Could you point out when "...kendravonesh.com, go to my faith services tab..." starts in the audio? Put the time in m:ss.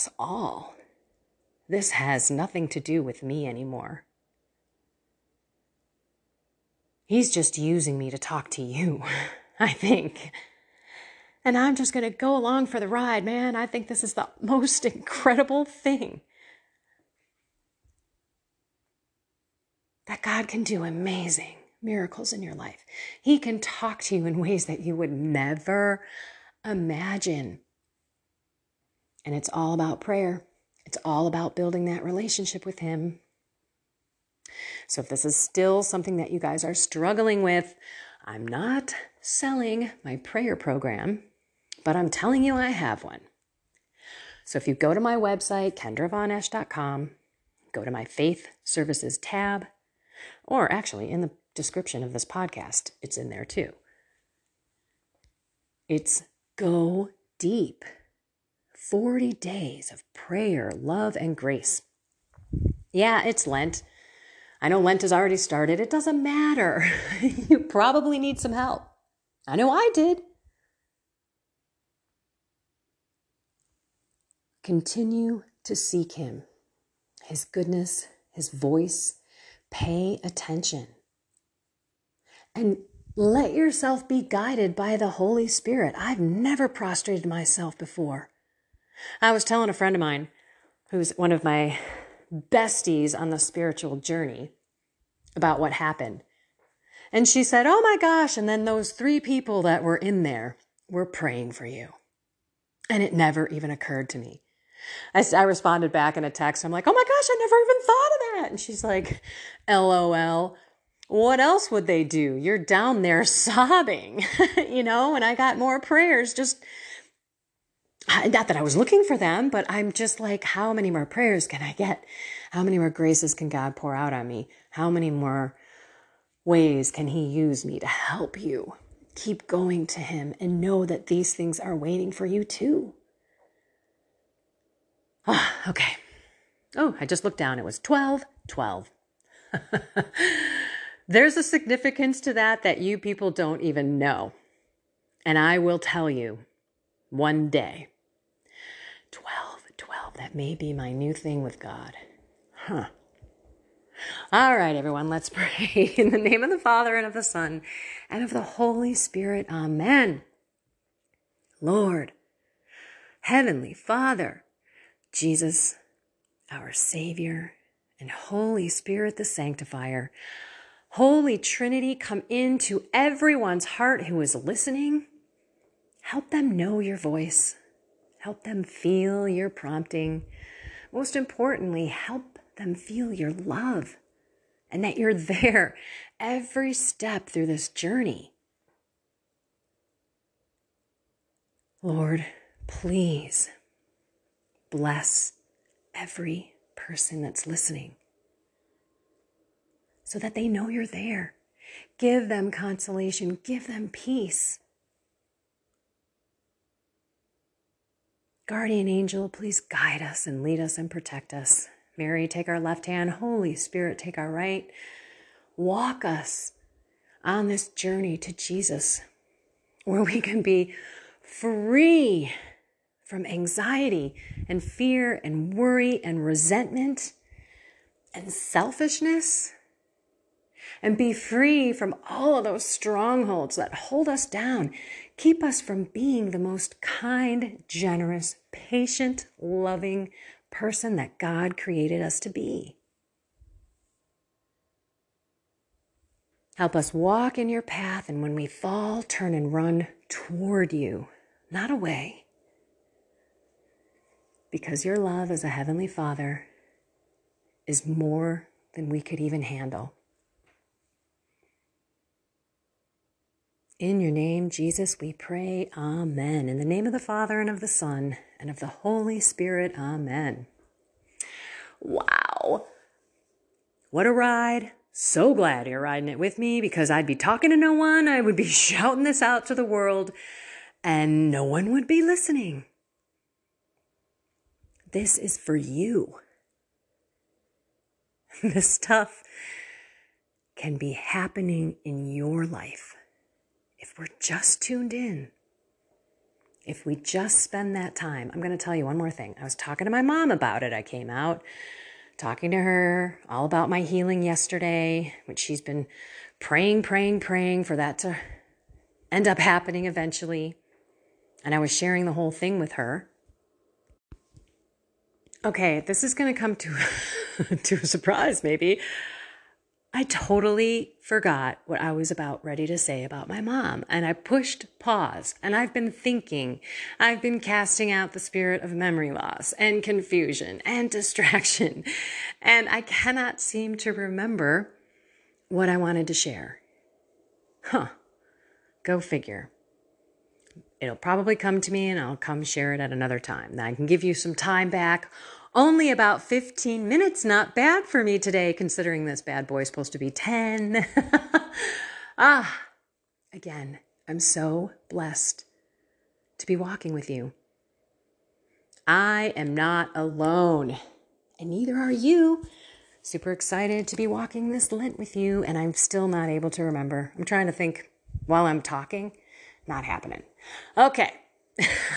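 0:45.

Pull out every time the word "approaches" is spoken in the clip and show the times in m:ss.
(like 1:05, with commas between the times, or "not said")
not said.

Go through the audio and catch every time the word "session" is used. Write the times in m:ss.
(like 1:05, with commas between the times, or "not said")
not said.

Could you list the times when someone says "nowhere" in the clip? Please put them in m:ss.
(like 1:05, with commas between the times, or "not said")
not said.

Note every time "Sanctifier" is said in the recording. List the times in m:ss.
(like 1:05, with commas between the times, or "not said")
2:49.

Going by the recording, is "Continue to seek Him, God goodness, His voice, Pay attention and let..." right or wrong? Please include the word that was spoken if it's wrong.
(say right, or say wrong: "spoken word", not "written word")
wrong: "His", not "God".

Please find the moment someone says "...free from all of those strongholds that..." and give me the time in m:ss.
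3:51.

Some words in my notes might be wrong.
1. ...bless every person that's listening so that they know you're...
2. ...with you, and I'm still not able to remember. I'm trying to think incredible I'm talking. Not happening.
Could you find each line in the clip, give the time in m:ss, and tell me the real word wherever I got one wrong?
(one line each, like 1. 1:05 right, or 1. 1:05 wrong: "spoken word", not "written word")
1. 3:14 right
2. 6:04 wrong: "while", not "incredible".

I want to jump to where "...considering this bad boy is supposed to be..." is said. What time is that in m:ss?
5:48.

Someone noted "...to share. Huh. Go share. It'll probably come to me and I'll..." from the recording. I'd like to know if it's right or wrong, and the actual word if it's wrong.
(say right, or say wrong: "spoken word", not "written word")
wrong: "figure", not "share".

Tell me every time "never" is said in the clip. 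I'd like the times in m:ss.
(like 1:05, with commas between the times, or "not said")
0:25, 1:26, 1:43, 1:47.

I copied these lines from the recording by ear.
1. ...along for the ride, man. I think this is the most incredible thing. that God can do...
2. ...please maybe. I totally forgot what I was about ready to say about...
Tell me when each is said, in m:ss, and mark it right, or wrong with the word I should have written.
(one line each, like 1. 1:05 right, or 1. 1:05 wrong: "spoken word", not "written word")
1. 0:12 right
2. 5:17 wrong: "surprise", not "please".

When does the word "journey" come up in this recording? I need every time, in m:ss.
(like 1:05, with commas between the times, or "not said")
1:33, 3:07, 3:37.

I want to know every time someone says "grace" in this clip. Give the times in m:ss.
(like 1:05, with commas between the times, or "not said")
1:01, 2:02.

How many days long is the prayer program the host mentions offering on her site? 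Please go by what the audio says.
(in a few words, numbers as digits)
40.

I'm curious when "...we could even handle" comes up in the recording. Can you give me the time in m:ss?
4:18.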